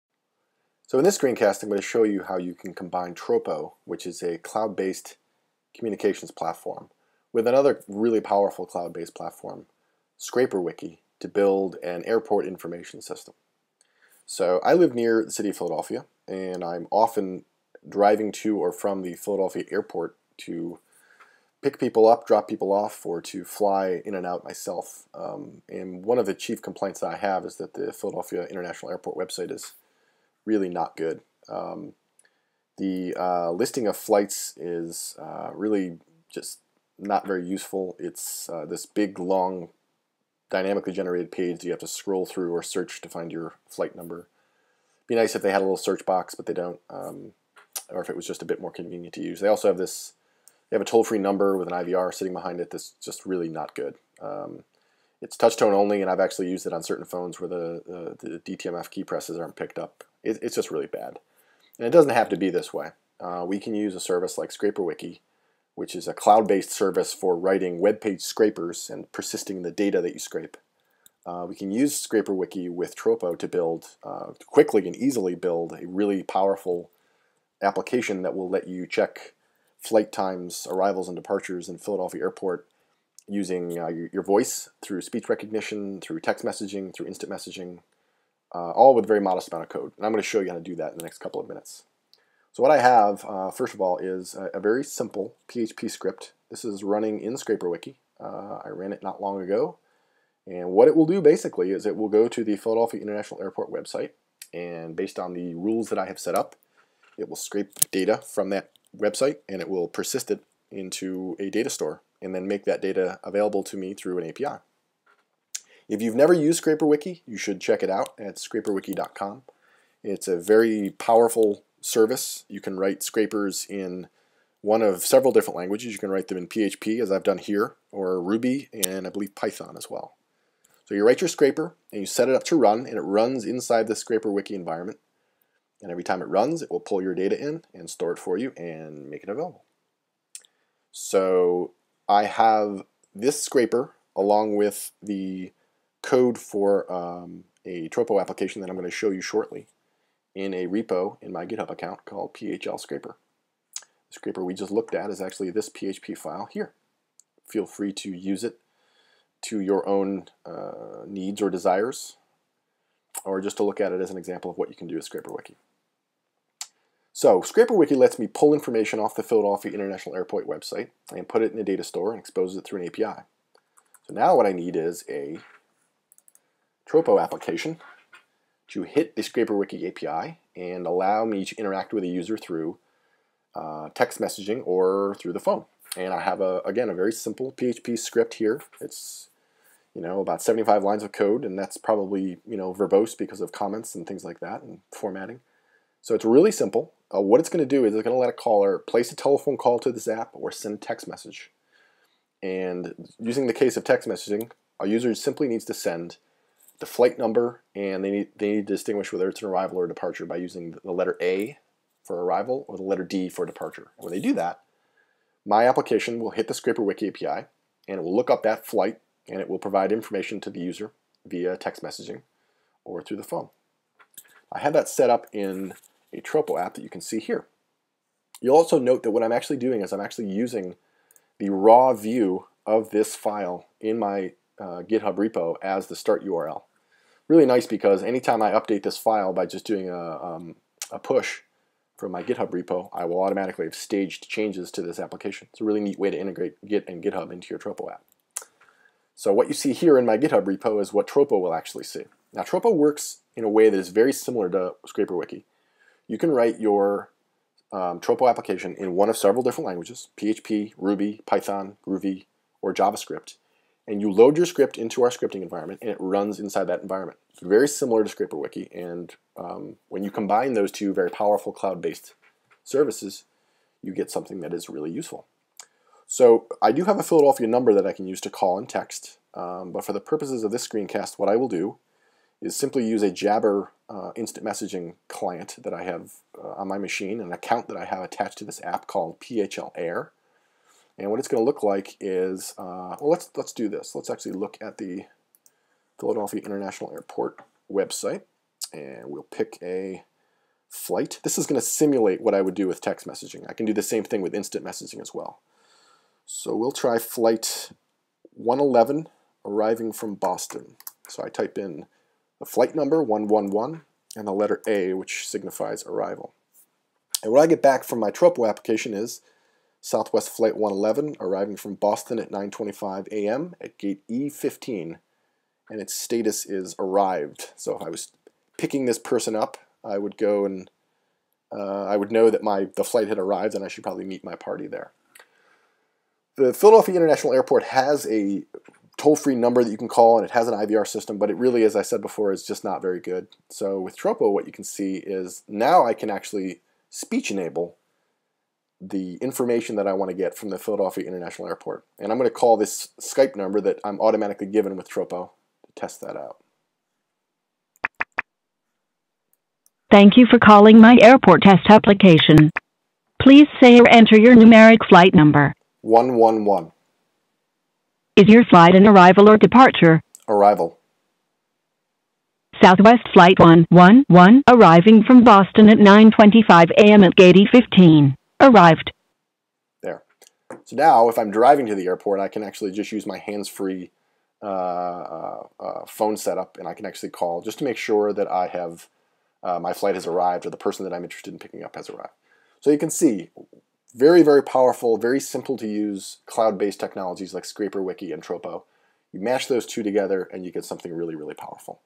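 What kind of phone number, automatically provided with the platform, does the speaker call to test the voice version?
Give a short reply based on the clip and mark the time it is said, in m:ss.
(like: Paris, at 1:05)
Skype number, at 5:52.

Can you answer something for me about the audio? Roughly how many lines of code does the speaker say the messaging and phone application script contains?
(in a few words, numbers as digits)
75.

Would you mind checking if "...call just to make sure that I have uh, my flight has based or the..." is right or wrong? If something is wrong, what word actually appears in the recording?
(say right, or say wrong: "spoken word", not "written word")
wrong: "arrived", not "based".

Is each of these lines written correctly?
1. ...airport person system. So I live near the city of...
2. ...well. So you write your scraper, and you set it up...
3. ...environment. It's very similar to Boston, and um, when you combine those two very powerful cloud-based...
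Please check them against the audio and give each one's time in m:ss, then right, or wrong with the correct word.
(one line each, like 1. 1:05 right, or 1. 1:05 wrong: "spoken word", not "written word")
1. 0:12 wrong: "information", not "person"
2. 2:09 right
3. 4:26 wrong: "Wiki", not "Boston".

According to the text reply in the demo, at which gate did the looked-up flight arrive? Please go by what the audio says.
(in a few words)
E15.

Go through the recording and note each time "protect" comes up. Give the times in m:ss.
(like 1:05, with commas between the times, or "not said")
not said.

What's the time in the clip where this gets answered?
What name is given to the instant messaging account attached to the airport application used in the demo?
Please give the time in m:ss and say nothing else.
4:49.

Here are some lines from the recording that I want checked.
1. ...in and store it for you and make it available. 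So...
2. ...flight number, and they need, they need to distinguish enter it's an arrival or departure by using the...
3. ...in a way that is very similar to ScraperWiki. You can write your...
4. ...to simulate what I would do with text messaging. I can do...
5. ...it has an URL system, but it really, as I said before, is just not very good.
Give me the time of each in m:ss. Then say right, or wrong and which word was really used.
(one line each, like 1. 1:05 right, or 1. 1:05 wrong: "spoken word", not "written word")
1. 2:17 right
2. 3:26 wrong: "whether", not "enter"
3. 4:13 right
4. 5:01 right
5. 5:40 wrong: "IVR", not "URL".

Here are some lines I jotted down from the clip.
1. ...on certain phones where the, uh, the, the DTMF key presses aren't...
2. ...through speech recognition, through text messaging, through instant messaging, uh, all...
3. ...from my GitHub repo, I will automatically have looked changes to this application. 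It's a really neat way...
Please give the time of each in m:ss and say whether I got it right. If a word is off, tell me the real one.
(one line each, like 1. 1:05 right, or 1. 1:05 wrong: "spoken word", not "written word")
1. 0:56 right
2. 1:24 right
3. 4:01 wrong: "staged", not "looked".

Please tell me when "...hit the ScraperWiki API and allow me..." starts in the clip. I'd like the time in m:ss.
2:58.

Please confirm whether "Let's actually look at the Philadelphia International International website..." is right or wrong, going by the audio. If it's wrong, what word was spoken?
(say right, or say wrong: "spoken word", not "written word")
wrong: "Airport", not "International".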